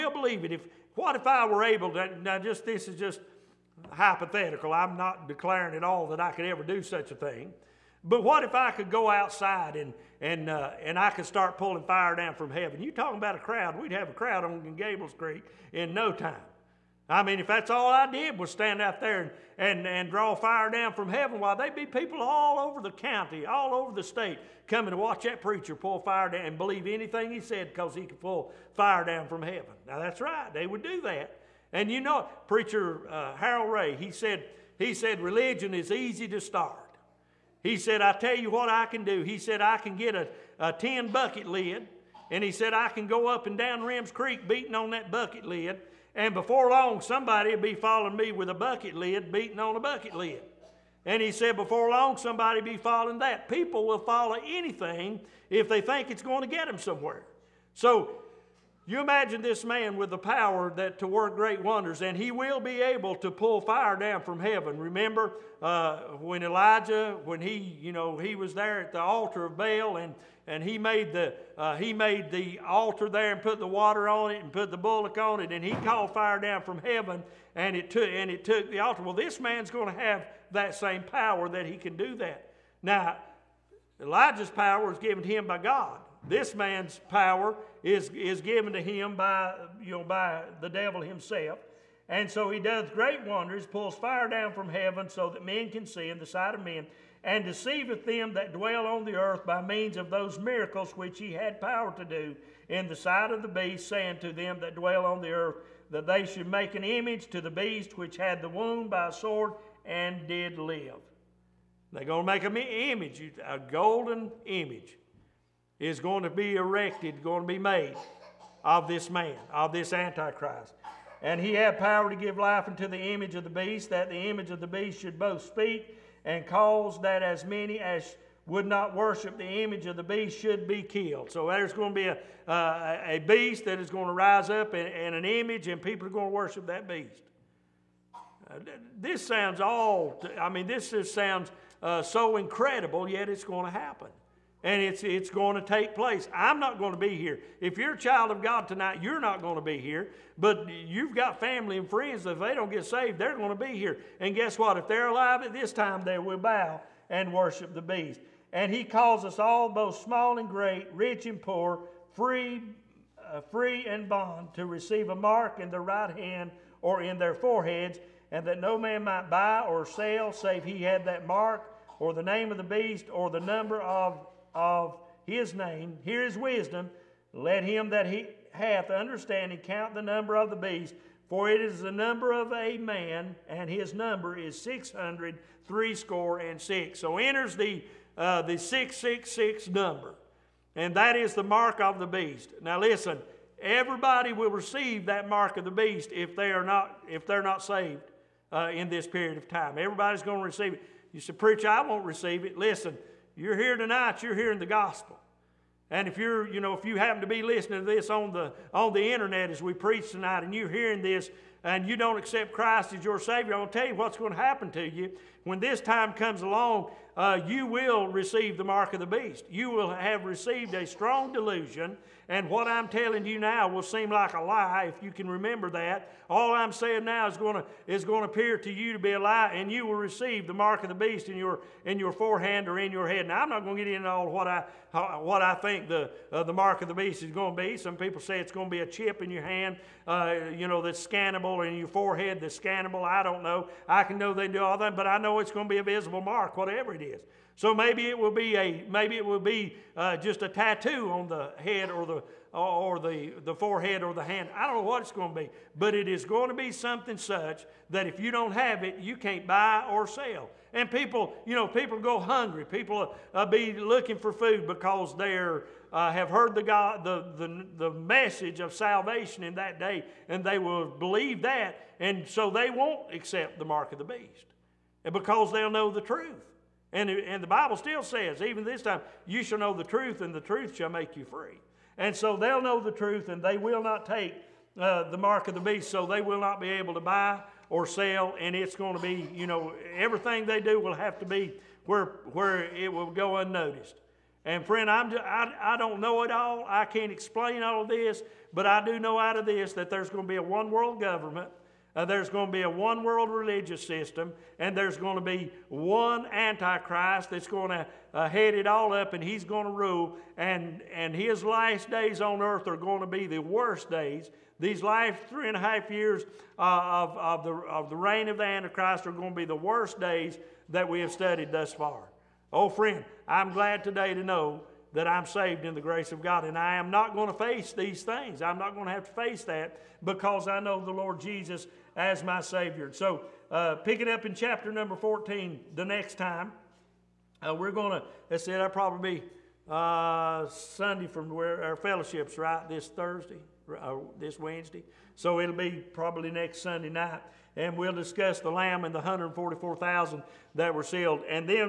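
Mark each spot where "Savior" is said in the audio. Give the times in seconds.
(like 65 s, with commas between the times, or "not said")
213 s, 332 s.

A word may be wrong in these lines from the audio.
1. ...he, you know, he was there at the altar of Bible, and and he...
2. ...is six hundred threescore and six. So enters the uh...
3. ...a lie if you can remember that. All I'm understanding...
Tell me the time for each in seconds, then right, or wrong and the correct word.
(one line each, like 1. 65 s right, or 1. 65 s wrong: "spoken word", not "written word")
1. 67 s wrong: "Baal", not "Bible"
2. 184 s right
3. 224 s wrong: "saying", not "understanding".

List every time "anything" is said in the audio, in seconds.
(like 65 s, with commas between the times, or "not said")
26 s, 54 s.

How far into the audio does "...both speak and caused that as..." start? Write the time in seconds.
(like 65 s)
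125 s.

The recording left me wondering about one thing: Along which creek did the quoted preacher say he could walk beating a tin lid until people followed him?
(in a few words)
Reems Creek.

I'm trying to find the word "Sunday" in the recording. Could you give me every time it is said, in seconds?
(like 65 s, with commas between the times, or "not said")
340 s, 346 s.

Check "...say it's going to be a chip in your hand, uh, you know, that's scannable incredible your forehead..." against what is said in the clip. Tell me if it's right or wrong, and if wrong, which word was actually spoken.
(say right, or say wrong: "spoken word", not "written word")
wrong: "scannable", not "incredible".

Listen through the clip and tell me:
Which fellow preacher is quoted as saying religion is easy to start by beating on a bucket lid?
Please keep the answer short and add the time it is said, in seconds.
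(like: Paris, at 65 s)
Harold Ray, at 33 s.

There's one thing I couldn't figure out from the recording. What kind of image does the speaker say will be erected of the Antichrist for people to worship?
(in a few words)
golden image.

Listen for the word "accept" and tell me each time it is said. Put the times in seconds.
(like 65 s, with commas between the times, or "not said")
212 s, 273 s.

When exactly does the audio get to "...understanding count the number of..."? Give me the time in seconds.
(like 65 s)
178 s.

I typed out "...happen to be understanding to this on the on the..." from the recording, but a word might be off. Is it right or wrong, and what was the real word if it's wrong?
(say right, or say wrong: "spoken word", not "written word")
wrong: "listening", not "understanding".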